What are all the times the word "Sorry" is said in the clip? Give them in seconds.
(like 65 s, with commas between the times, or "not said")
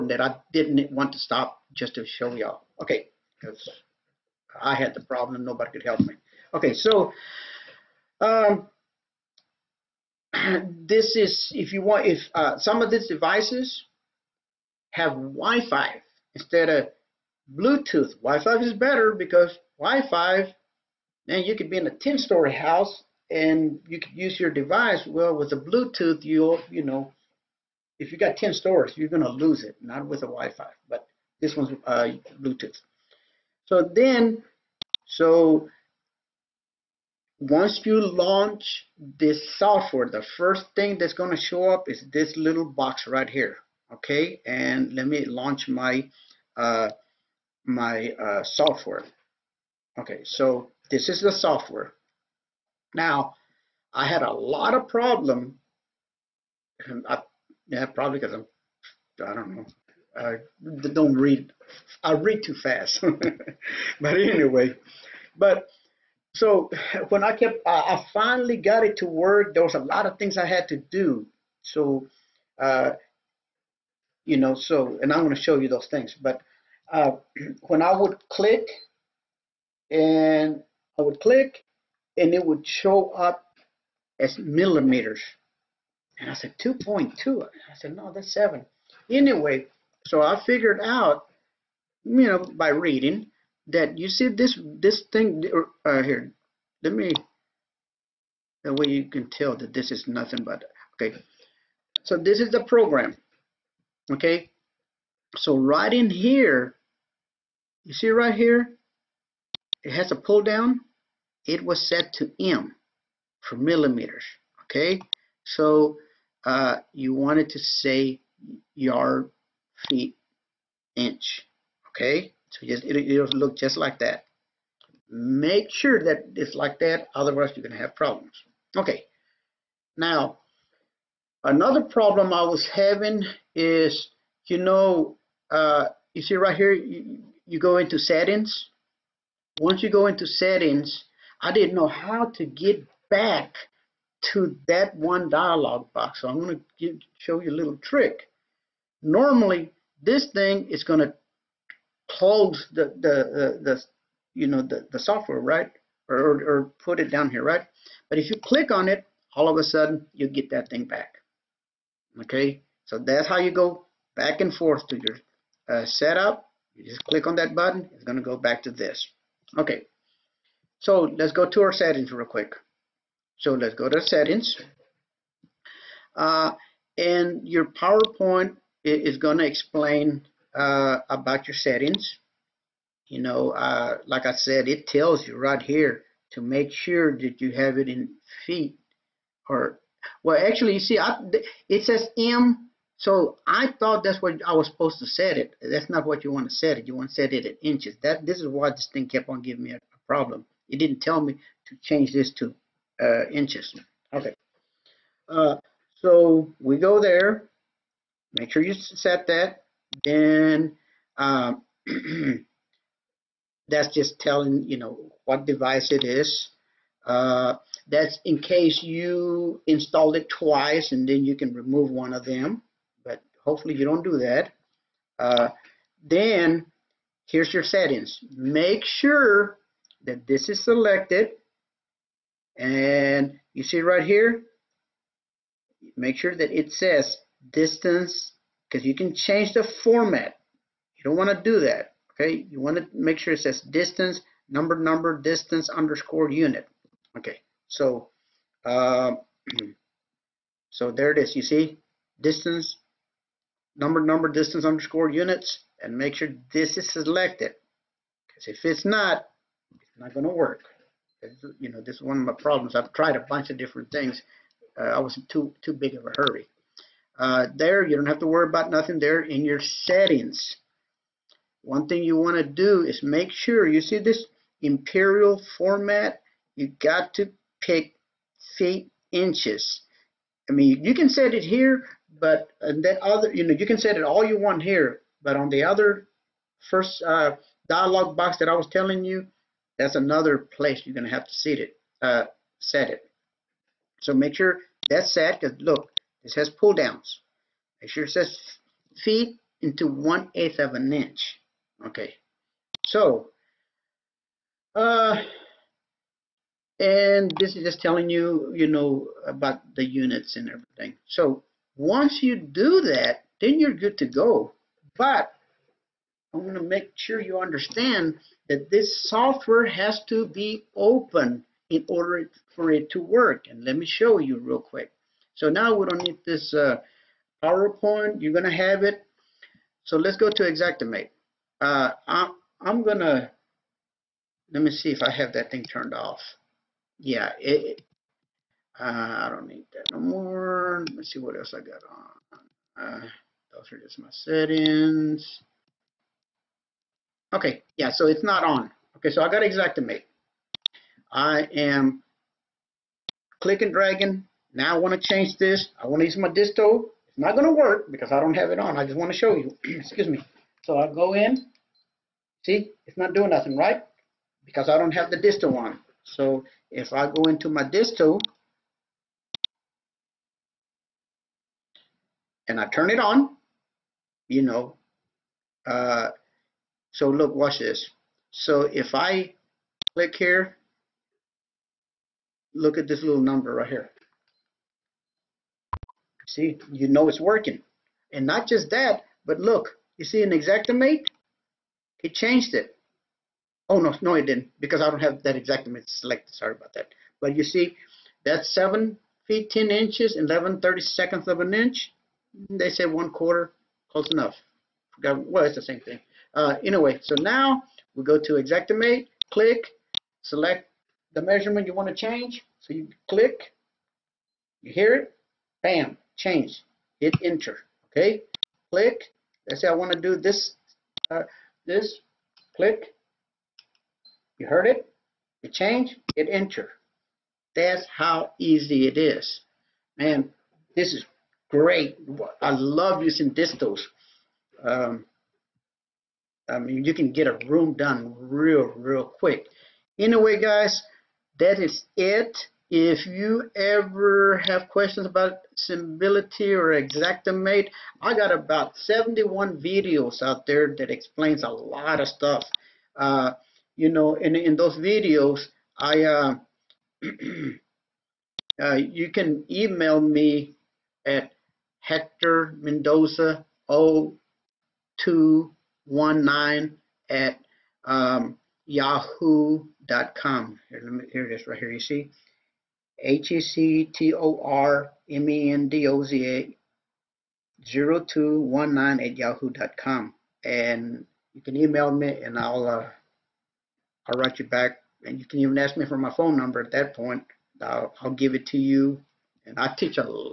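396 s.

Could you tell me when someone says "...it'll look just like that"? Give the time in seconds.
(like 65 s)
122 s.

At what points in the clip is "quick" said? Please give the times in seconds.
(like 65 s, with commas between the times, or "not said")
172 s, 324 s, 439 s.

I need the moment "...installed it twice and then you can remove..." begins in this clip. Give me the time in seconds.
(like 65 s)
219 s.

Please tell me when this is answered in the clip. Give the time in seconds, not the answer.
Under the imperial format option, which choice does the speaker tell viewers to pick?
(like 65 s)
278 s.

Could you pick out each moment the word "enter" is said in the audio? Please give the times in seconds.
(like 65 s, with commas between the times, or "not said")
417 s, 426 s.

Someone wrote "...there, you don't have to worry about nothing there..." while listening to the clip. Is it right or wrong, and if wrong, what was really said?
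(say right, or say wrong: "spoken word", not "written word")
right.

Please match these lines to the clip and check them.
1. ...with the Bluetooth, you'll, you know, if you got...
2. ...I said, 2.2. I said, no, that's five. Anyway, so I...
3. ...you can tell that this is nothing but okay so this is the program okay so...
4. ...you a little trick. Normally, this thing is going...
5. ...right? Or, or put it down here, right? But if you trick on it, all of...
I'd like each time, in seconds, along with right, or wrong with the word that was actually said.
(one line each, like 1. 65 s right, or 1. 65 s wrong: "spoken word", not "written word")
1. 25 s right
2. 86 s wrong: "seven", not "five"
3. 98 s right
4. 147 s right
5. 155 s wrong: "click", not "trick".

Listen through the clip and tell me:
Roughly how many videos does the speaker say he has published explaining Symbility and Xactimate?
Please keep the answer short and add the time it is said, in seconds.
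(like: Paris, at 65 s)
71, at 448 s.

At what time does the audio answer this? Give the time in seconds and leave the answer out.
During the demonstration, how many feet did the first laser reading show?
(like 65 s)
398 s.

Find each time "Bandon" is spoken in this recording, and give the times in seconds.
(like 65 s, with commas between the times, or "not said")
not said.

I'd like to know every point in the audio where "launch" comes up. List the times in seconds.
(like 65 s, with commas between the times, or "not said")
37 s, 45 s.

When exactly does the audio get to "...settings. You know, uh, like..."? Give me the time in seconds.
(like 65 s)
181 s.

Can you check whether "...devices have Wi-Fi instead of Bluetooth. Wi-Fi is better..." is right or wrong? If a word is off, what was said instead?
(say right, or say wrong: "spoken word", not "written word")
right.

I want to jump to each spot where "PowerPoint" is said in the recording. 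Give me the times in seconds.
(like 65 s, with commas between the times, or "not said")
177 s, 327 s.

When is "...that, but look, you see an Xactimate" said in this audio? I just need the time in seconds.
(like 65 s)
388 s.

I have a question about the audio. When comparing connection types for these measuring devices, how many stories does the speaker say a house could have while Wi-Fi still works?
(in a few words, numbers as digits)
10.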